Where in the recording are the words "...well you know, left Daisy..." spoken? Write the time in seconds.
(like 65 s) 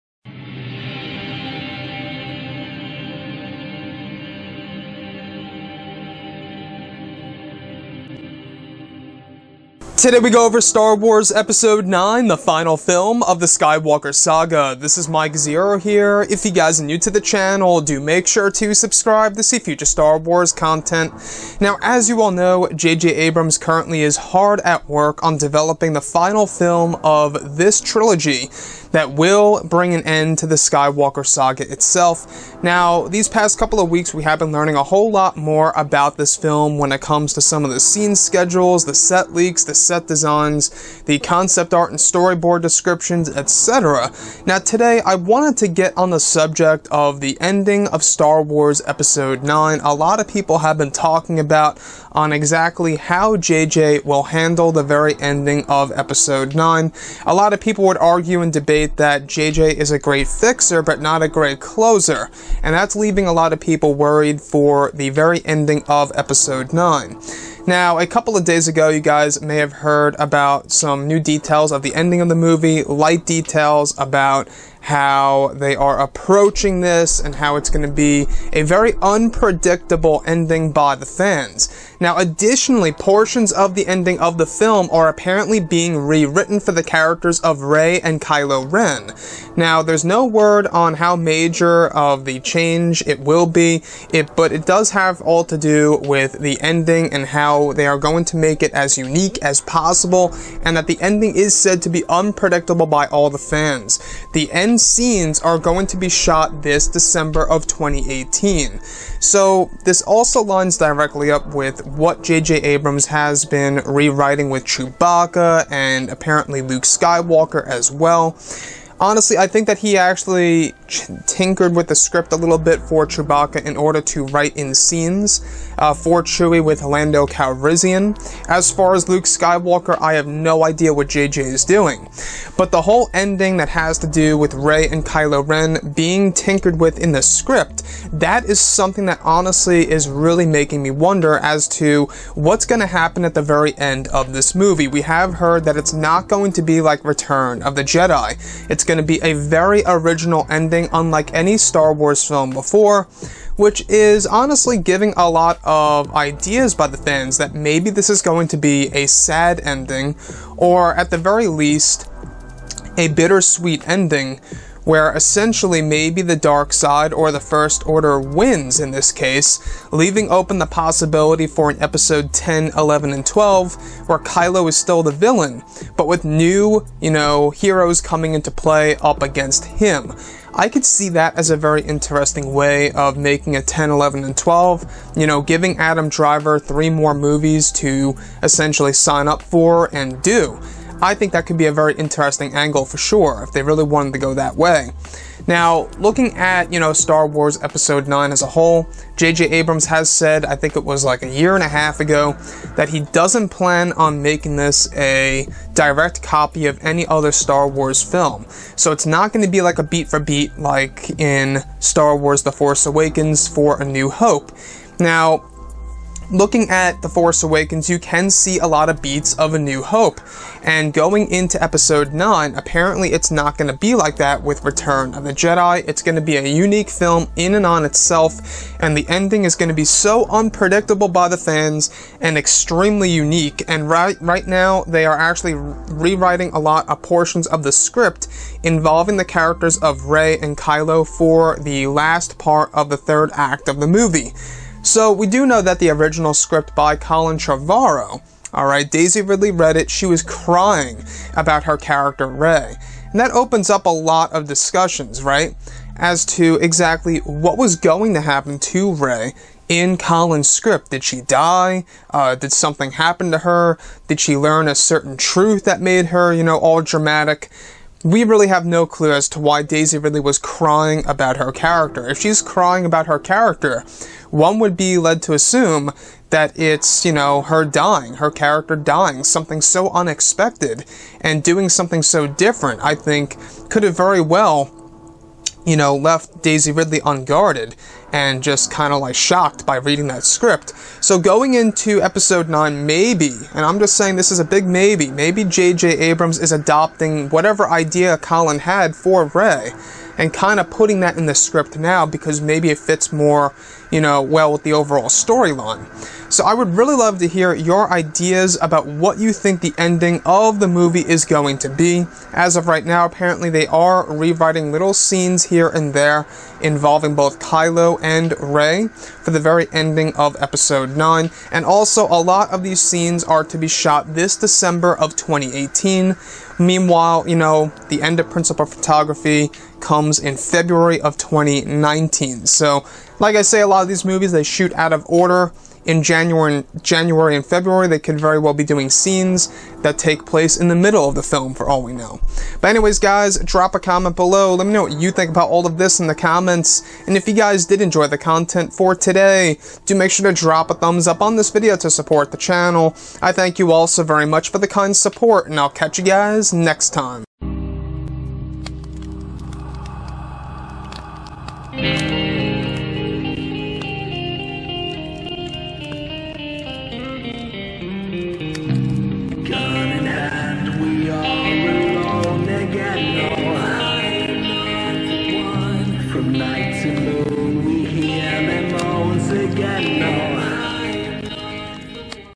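284 s.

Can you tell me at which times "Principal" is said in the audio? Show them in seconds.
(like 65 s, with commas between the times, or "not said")
328 s.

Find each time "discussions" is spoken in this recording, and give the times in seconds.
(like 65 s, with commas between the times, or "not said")
254 s.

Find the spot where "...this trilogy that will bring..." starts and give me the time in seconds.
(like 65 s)
27 s.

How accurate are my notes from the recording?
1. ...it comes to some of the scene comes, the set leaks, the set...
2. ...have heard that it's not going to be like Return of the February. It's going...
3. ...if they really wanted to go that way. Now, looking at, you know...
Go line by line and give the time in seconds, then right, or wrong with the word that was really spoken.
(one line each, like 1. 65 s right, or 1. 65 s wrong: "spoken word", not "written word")
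1. 36 s wrong: "schedules", not "comes"
2. 145 s wrong: "Jedi", not "February"
3. 193 s right.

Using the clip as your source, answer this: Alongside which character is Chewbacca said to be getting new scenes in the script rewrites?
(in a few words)
Lando Calrissian.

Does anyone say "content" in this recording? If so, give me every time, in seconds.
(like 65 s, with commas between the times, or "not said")
20 s, 348 s.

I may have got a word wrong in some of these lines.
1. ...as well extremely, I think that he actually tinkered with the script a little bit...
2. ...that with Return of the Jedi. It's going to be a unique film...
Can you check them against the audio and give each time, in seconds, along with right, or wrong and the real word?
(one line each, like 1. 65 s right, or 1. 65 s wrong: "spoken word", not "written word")
1. 117 s wrong: "honestly", not "extremely"
2. 224 s right.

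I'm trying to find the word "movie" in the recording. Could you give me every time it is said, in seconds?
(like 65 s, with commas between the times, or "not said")
72 s, 144 s, 187 s, 243 s, 310 s, 334 s.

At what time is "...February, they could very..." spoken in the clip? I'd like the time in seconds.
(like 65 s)
337 s.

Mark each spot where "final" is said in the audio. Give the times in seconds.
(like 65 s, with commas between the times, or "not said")
12 s, 26 s.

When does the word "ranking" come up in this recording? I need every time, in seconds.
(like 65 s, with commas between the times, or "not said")
not said.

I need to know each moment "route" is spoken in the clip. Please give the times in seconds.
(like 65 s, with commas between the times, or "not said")
not said.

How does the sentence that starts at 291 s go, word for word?
So going into episode 9, maybe, and I'm just saying this is a big maybe, maybe J.J.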